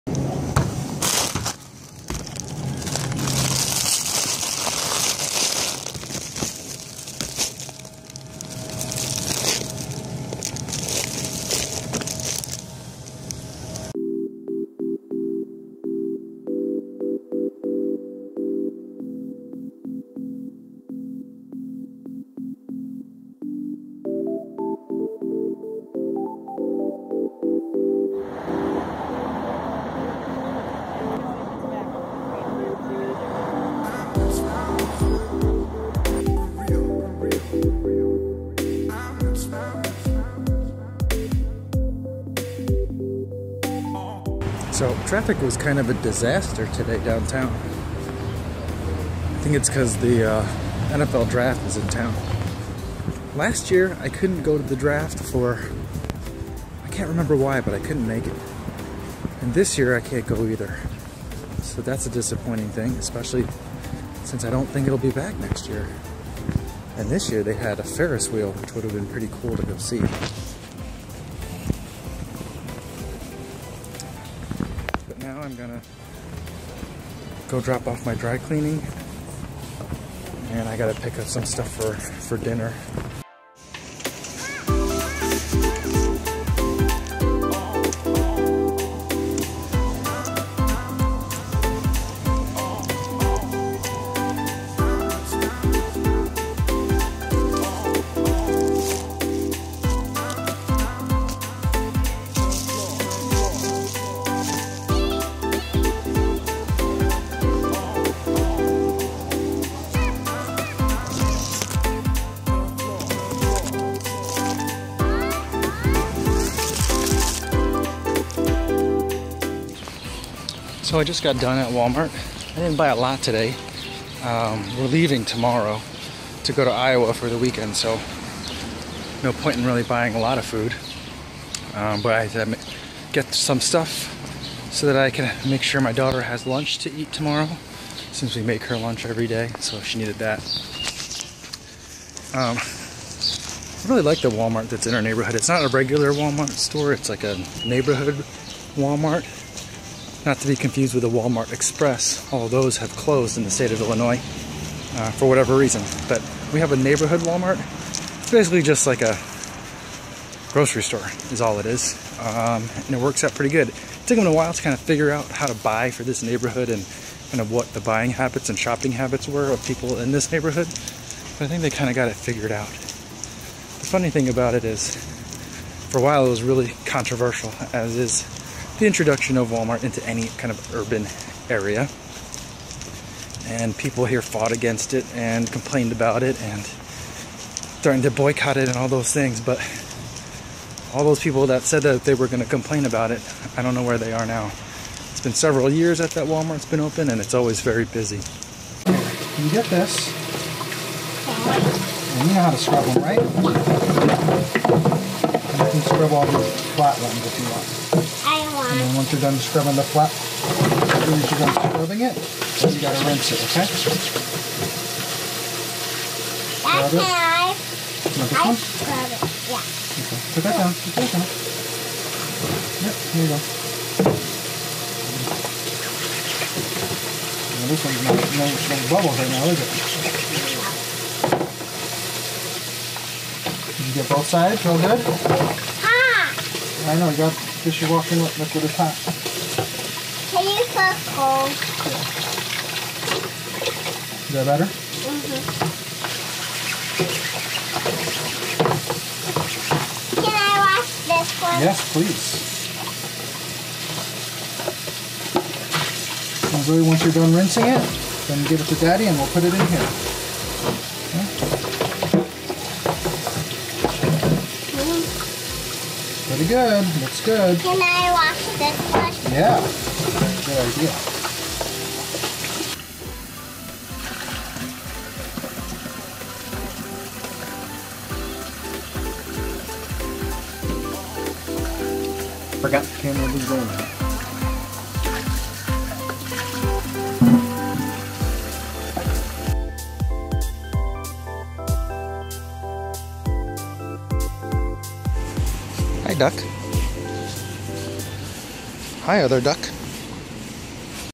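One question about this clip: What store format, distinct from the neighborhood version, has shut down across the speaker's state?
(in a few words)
Walmart Express.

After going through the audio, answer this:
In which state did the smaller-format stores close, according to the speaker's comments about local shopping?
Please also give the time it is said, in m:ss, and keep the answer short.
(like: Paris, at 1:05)
Illinois, at 2:33.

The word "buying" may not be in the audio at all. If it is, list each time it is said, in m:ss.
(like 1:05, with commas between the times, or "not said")
2:09, 2:47.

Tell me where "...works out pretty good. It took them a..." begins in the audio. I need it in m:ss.
2:42.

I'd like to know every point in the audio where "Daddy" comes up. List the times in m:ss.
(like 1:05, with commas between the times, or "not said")
4:18.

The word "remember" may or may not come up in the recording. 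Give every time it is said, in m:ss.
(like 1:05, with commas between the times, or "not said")
0:57.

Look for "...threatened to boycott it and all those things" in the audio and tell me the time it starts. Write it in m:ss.
3:07.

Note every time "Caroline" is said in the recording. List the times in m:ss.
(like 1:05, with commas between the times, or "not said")
not said.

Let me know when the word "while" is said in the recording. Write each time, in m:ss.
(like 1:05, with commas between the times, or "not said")
2:44, 2:56.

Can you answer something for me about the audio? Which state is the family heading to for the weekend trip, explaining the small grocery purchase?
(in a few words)
Iowa.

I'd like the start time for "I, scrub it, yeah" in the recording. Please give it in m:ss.
3:37.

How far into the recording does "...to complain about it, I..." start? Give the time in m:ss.
3:12.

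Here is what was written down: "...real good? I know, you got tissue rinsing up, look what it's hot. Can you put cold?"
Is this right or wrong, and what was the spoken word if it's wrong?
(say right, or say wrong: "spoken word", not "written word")
wrong: "washing", not "rinsing".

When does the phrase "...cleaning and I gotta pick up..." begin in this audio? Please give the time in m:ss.
1:18.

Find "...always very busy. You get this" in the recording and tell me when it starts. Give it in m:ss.
3:17.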